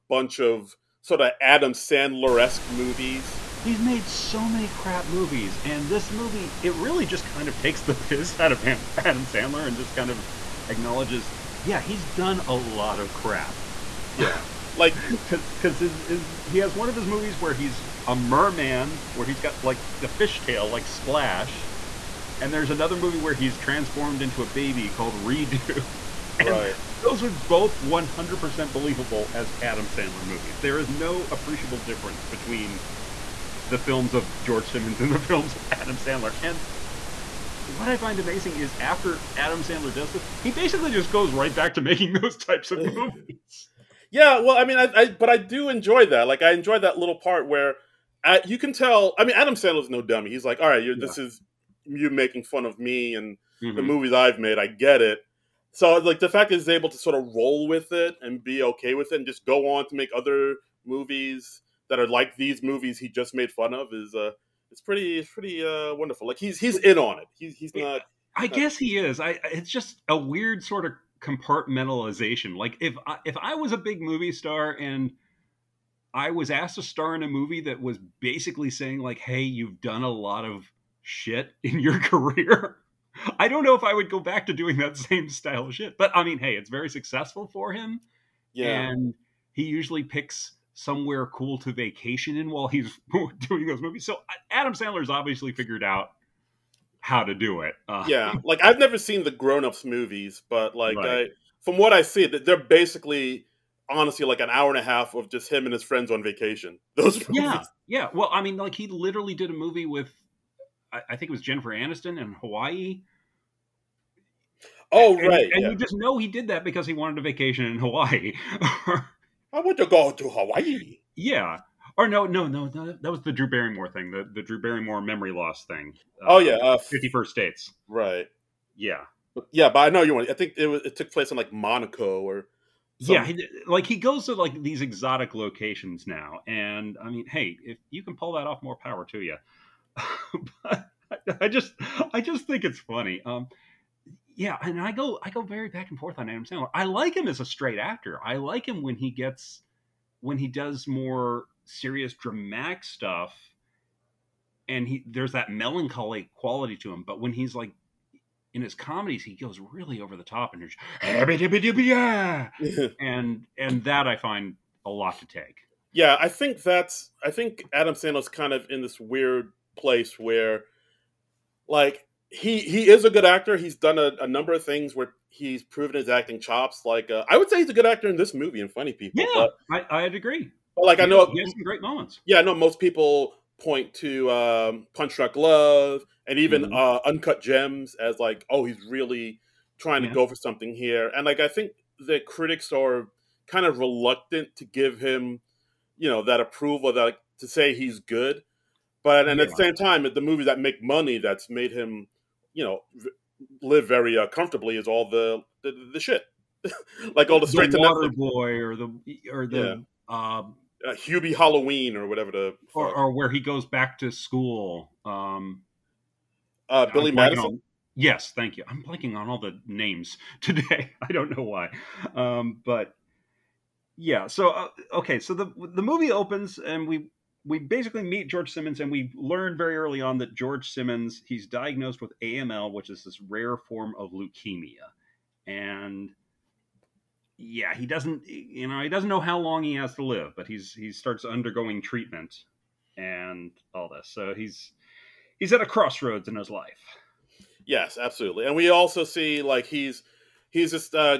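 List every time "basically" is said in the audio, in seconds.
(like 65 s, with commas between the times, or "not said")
40 s, 78 s, 102 s, 227 s.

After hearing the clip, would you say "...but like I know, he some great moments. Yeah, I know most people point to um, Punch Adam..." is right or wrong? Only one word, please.
wrong.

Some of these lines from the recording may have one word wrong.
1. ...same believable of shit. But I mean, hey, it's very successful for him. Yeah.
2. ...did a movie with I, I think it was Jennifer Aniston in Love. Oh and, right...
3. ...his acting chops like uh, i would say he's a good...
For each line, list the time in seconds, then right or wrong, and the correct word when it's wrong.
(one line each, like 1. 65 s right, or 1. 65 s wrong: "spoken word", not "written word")
1. 84 s wrong: "style", not "believable"
2. 109 s wrong: "Hawaii", not "Love"
3. 175 s right.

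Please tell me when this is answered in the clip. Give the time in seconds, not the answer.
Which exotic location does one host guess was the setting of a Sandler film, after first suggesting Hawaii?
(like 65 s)
131 s.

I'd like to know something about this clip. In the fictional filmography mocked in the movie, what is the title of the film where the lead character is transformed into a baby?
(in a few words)
Redo.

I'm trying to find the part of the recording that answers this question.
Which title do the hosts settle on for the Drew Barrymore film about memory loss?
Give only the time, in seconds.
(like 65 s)
126 s.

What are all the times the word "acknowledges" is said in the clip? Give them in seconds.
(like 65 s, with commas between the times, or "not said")
10 s.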